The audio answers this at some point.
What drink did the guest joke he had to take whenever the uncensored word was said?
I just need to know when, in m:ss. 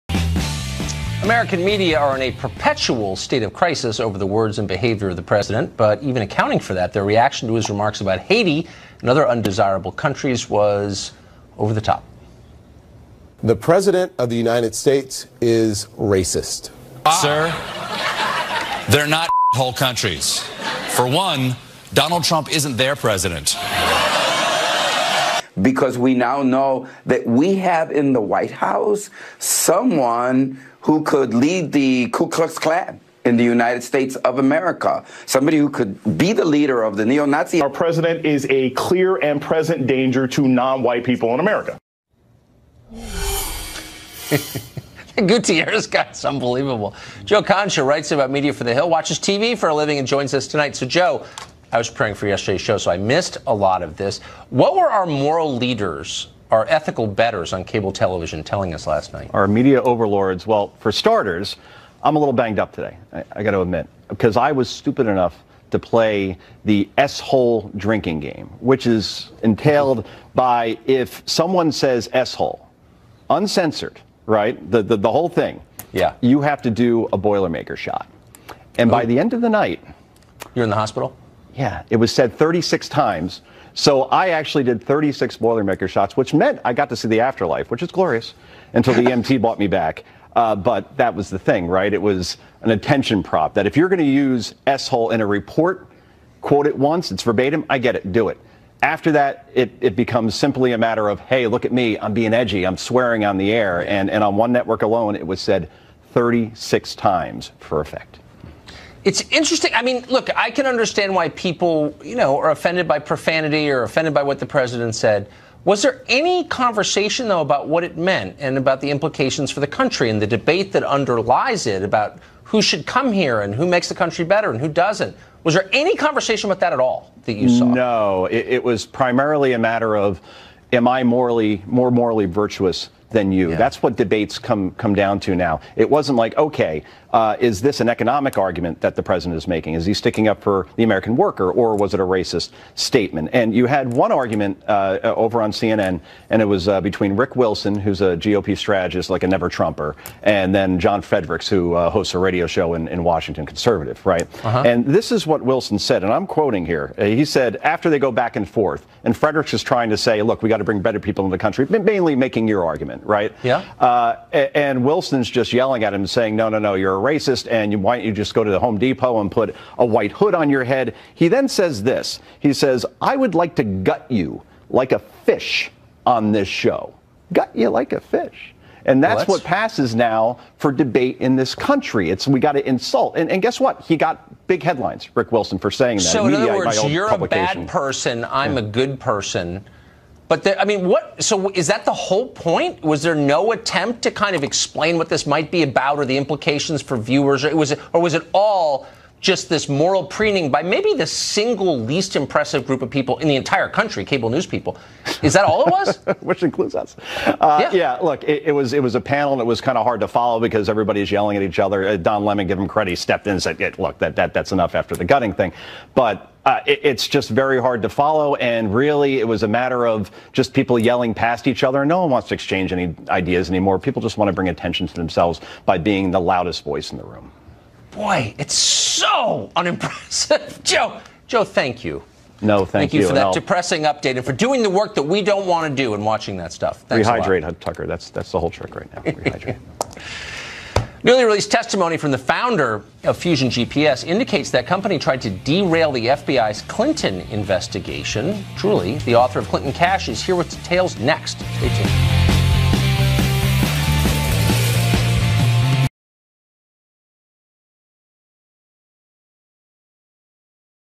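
1:17.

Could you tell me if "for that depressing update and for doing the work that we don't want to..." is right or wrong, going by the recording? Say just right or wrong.
right.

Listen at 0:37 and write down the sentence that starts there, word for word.
Our president is a clear and present danger to non white people in America.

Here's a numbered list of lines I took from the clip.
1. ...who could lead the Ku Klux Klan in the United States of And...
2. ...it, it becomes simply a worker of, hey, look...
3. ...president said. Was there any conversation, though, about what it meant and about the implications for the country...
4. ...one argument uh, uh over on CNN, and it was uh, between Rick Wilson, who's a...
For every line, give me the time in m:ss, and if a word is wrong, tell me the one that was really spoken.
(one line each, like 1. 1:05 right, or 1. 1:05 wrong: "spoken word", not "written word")
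1. 0:30 wrong: "America", not "And"
2. 1:39 wrong: "matter", not "worker"
3. 1:54 right
4. 2:23 right.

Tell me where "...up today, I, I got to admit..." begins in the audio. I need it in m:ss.
1:02.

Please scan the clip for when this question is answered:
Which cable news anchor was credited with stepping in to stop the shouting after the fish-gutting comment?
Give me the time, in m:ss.
3:31.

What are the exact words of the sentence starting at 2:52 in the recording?
He says, "I would like to gut you like a fish on this show.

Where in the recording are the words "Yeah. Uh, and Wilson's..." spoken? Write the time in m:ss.
2:43.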